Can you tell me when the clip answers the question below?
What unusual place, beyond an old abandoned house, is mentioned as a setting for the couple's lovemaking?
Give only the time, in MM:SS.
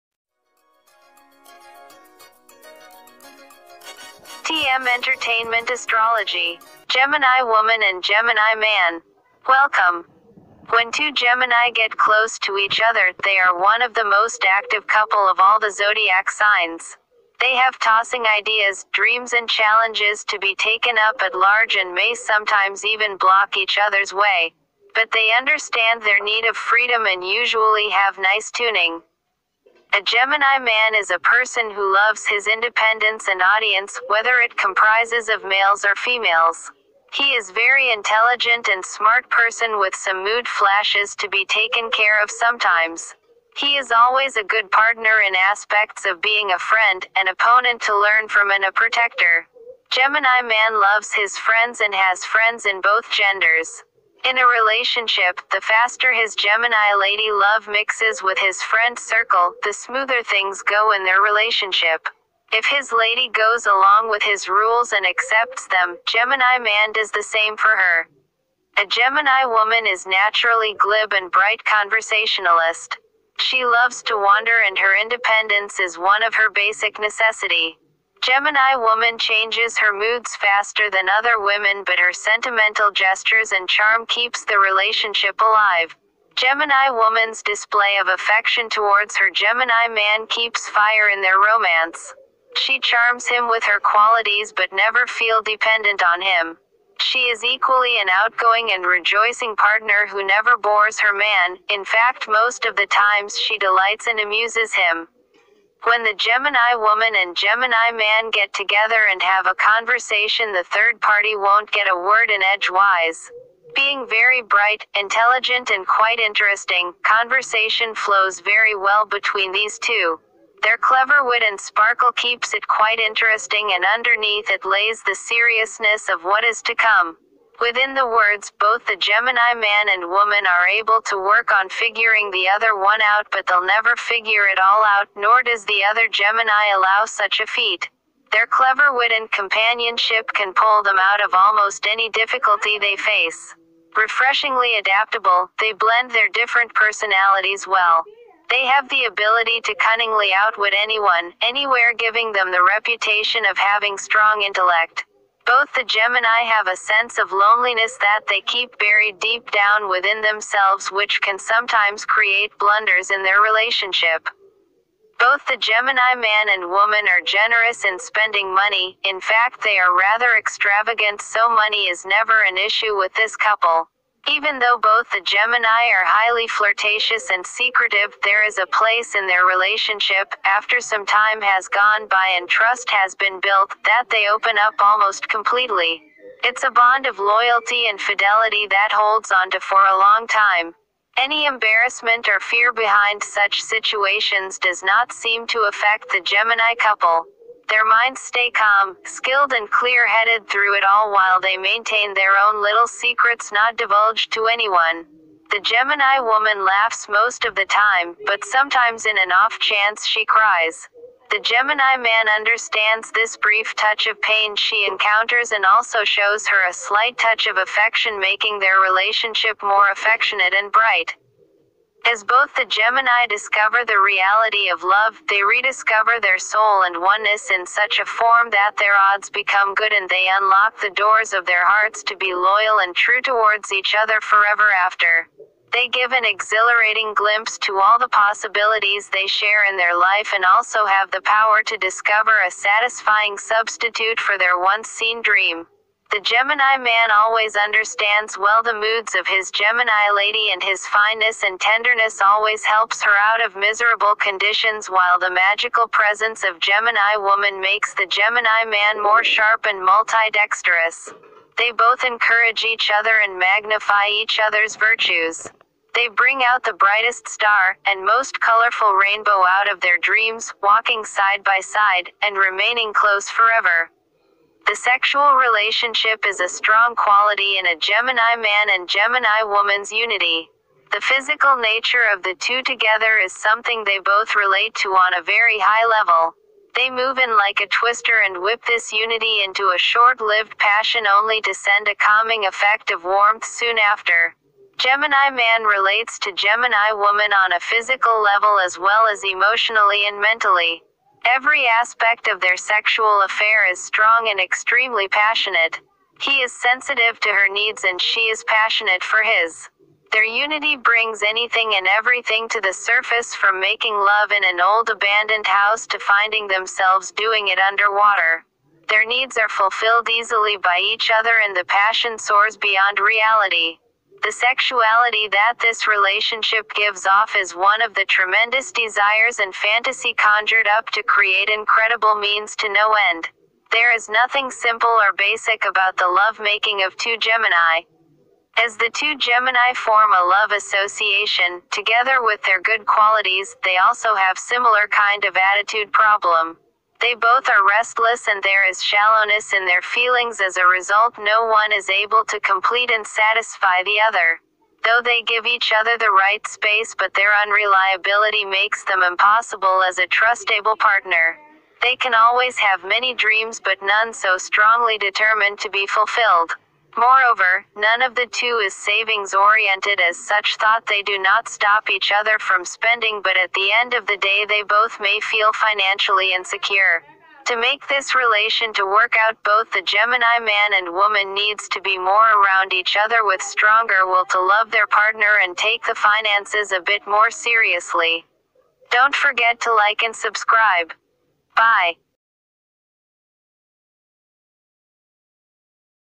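05:17.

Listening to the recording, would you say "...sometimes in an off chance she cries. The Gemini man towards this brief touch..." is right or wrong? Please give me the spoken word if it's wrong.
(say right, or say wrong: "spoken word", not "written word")
wrong: "understands", not "towards".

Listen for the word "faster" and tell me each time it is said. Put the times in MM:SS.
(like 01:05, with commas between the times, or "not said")
00:55, 01:20.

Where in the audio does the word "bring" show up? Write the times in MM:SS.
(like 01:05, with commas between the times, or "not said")
04:26, 05:10.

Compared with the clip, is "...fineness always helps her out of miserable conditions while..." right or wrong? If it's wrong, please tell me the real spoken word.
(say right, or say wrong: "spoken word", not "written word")
wrong: "tenderness", not "fineness".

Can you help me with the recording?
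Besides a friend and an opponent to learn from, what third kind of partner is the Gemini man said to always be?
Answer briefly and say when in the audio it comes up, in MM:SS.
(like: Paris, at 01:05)
a protector, at 00:48.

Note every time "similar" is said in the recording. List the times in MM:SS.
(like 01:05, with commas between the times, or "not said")
05:44.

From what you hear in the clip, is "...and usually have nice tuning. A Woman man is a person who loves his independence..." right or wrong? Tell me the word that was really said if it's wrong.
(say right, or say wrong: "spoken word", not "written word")
wrong: "Gemini", not "Woman".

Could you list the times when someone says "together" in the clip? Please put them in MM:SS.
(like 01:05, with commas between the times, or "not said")
01:48, 04:42, 05:41.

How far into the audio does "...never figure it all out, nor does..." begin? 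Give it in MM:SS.
02:13.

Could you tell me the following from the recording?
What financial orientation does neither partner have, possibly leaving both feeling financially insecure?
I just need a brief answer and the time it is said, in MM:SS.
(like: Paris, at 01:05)
savings oriented, at 06:08.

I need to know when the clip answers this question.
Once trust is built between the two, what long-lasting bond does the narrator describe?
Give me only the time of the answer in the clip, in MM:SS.
03:07.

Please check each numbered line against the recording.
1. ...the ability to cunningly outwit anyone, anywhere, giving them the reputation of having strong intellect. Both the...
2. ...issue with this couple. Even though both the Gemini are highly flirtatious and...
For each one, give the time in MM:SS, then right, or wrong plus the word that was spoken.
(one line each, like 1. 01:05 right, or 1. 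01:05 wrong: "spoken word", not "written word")
1. 02:28 right
2. 02:52 right.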